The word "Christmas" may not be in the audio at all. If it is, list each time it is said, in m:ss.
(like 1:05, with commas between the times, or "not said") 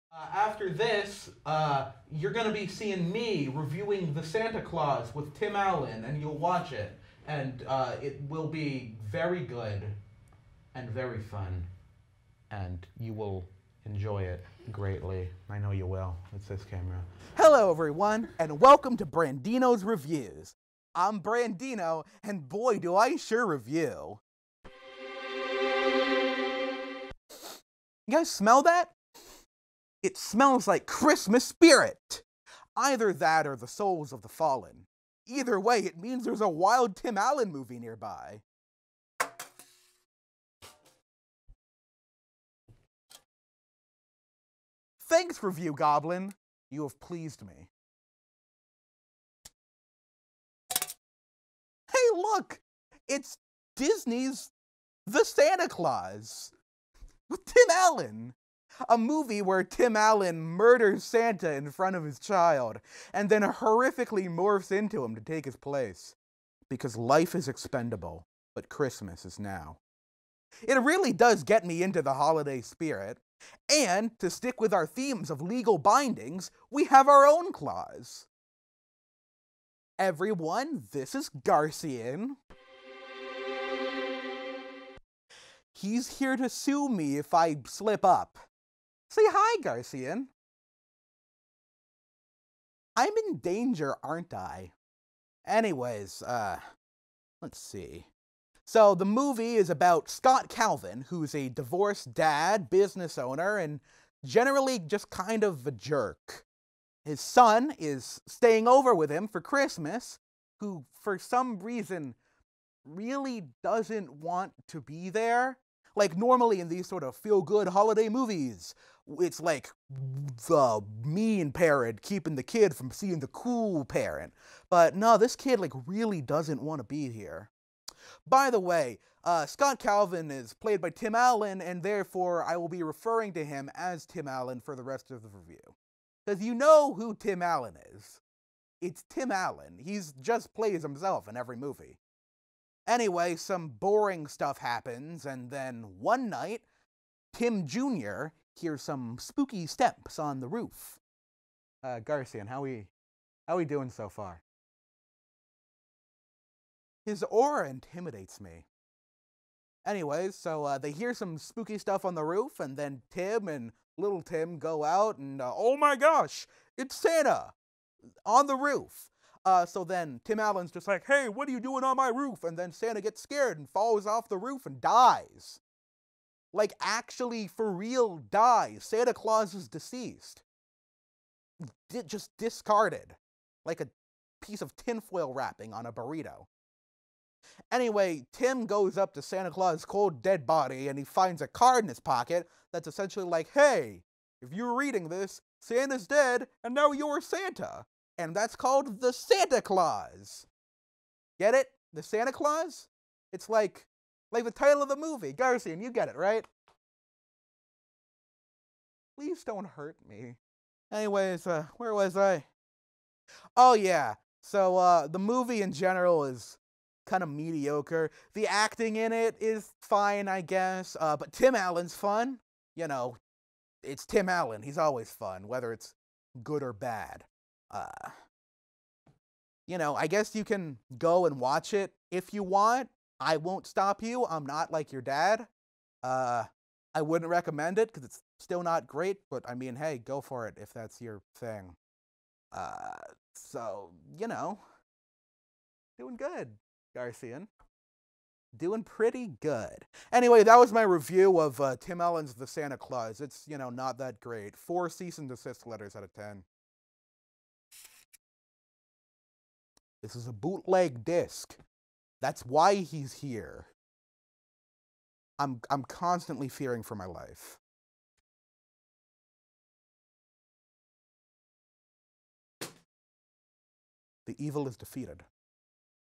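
0:30, 1:08, 1:49.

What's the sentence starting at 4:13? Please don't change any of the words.
It's, you know, not that great.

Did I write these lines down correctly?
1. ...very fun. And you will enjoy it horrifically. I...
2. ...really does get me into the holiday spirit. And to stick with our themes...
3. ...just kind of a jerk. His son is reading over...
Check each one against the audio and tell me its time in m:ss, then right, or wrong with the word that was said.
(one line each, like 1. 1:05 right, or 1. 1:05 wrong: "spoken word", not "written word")
1. 0:10 wrong: "greatly", not "horrifically"
2. 1:10 right
3. 1:44 wrong: "staying", not "reading".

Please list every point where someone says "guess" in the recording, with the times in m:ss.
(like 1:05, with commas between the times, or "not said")
3:40, 3:50.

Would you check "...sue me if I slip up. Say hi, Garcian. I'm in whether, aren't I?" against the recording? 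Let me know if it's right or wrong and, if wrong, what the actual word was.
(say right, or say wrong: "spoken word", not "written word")
wrong: "danger", not "whether".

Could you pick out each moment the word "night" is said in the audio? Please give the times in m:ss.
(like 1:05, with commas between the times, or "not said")
2:26.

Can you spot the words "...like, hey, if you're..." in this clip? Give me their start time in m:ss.
3:13.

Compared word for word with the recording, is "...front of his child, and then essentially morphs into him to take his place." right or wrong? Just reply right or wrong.
wrong.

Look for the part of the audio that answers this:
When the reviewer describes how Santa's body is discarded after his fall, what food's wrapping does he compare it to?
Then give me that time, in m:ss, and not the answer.
3:05.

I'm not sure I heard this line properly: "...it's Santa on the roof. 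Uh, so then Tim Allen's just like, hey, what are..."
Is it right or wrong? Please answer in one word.
right.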